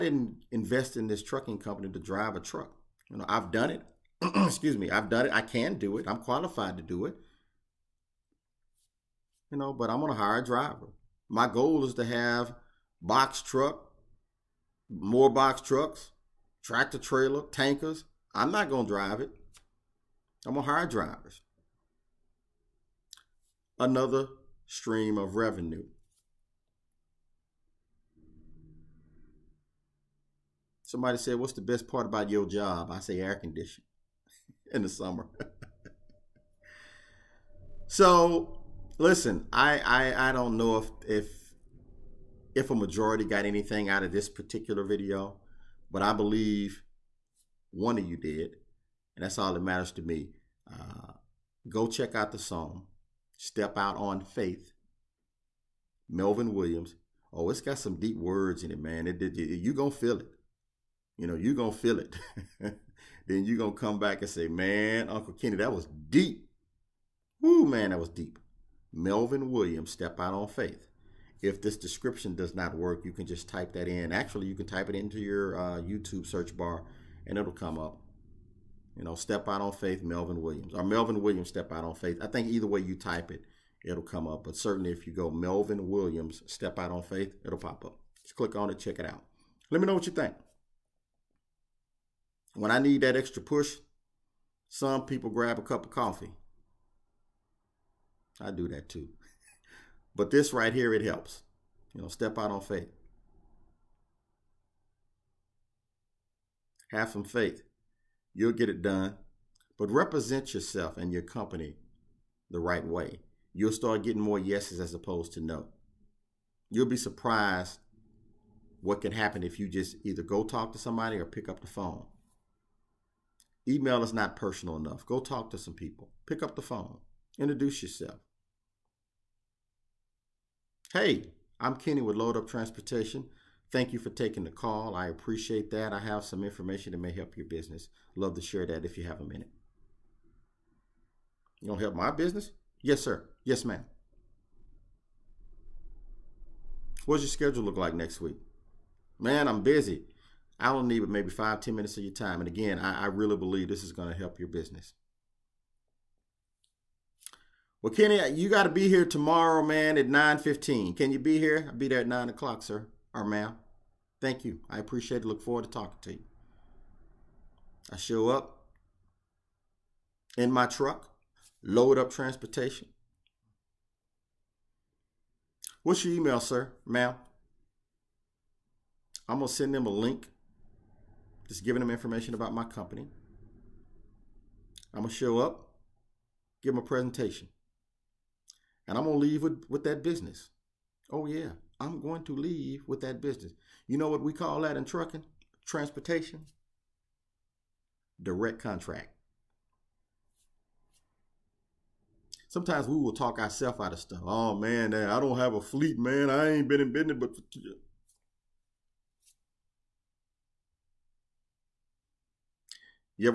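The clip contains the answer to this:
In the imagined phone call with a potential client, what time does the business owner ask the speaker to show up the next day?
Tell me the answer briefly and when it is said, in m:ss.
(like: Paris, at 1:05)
9:15, at 2:40.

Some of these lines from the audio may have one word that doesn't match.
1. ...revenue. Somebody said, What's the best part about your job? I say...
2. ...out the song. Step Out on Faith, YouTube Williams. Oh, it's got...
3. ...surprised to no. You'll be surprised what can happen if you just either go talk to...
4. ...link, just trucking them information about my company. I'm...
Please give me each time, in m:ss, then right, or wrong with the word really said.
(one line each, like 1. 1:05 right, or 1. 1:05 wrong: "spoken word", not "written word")
1. 0:25 right
2. 0:52 wrong: "Melvin", not "YouTube"
3. 1:54 wrong: "opposed", not "surprised"
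4. 2:59 wrong: "giving", not "trucking".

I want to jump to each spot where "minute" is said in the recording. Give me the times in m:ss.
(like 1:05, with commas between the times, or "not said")
2:19, 2:31.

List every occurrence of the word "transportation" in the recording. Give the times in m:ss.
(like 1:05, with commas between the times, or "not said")
2:12, 2:52, 3:15.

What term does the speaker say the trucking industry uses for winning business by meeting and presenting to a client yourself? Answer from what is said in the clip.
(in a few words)
Direct contract.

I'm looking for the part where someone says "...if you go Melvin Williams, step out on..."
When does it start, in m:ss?
1:24.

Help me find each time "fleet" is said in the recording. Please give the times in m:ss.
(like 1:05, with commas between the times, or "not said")
3:25.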